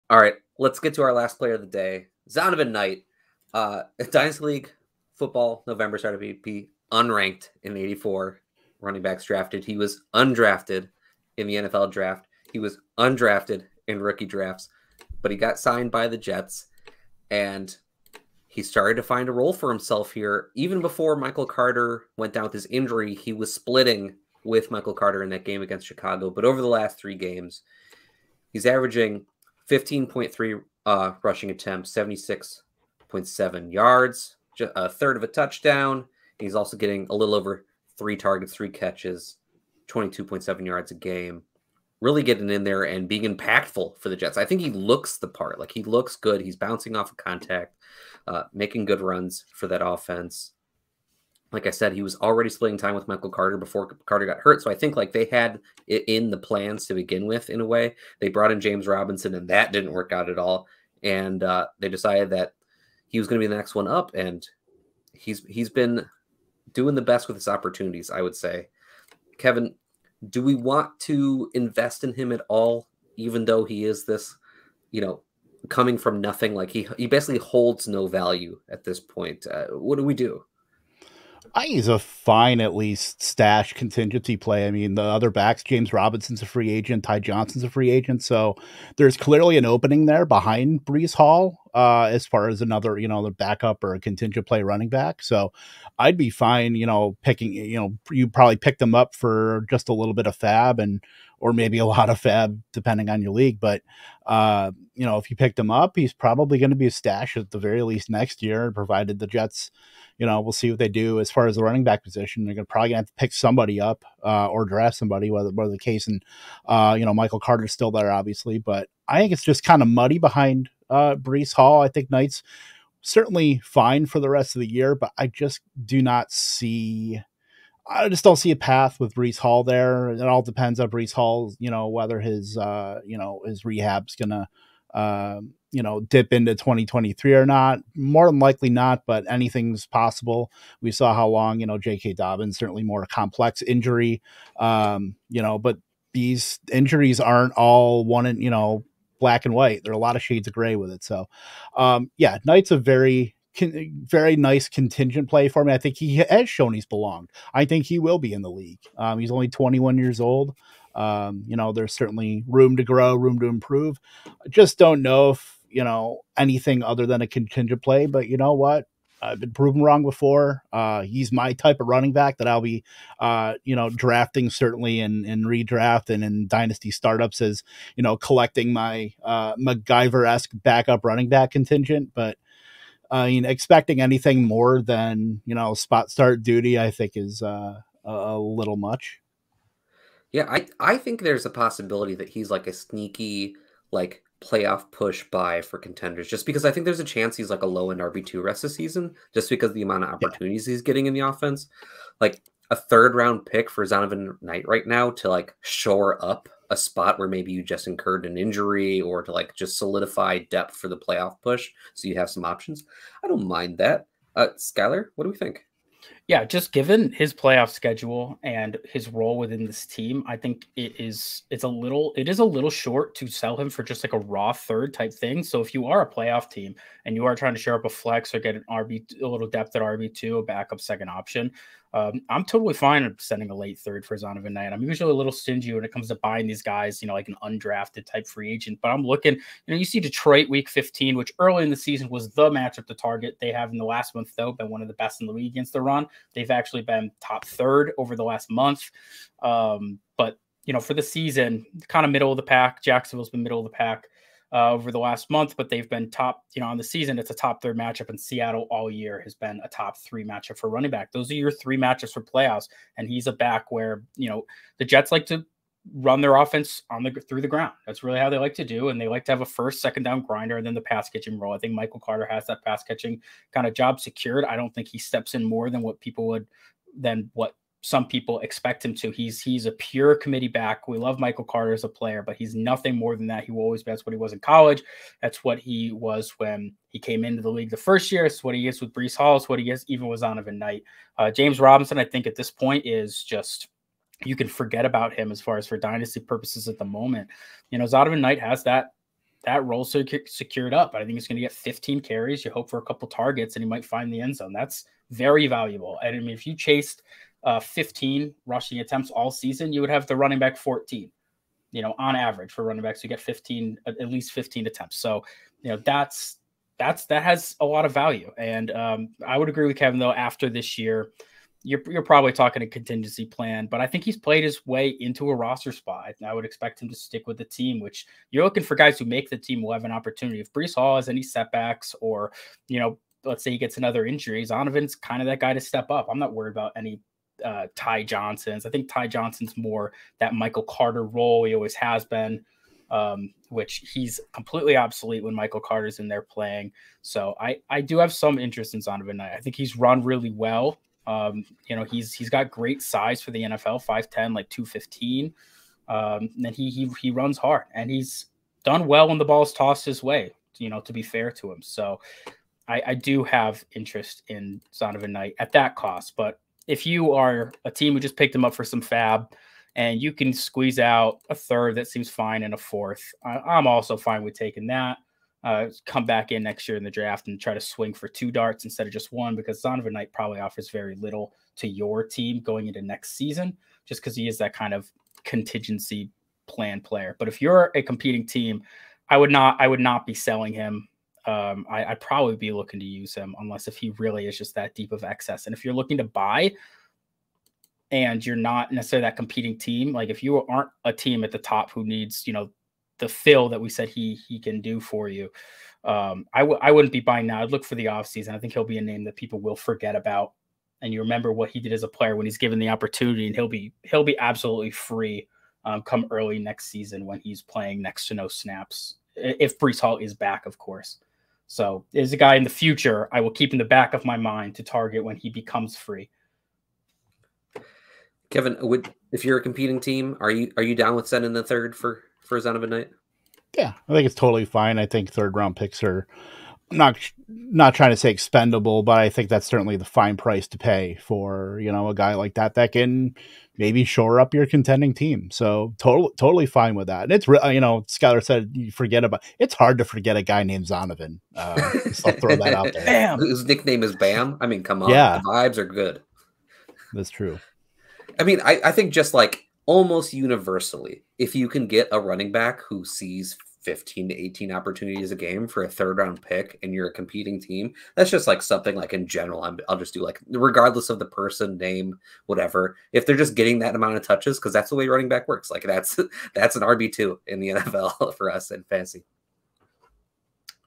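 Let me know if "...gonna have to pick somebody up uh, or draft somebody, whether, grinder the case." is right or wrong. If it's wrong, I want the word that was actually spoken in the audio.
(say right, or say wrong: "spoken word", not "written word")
wrong: "whether", not "grinder".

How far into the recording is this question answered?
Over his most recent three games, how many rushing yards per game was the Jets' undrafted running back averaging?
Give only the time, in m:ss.
0:31.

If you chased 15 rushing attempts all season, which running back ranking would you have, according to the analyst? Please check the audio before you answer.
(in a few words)
RB14.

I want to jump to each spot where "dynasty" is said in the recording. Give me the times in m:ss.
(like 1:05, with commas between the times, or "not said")
0:04, 2:56, 4:55.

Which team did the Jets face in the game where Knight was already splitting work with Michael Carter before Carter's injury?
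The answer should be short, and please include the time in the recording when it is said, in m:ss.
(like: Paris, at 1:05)
Chicago, at 0:25.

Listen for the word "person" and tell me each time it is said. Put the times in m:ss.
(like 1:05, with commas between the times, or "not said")
7:51.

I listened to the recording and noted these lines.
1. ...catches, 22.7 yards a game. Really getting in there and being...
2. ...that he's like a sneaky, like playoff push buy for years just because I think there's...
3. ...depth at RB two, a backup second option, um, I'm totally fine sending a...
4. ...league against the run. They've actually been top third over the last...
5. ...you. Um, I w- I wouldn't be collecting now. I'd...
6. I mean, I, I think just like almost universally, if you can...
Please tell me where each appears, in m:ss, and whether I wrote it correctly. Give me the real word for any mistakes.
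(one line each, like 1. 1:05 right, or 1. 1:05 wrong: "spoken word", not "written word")
1. 0:38 right
2. 3:12 wrong: "contenders", not "years"
3. 3:49 right
4. 4:05 right
5. 6:45 wrong: "buying", not "collecting"
6. 7:38 right.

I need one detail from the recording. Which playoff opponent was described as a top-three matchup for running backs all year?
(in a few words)
Seattle.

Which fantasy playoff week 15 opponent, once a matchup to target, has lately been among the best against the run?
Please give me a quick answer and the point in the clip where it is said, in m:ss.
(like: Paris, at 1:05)
Detroit, at 3:59.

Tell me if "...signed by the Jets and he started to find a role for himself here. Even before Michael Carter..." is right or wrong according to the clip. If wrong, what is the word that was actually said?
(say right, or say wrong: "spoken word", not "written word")
right.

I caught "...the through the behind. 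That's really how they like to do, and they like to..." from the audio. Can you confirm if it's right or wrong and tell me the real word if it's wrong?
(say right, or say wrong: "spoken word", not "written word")
wrong: "ground", not "behind".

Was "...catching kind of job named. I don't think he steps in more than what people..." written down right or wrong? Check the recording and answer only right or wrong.
wrong.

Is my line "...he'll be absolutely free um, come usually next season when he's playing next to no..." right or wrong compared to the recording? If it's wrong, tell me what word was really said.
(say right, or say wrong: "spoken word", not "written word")
wrong: "early", not "usually".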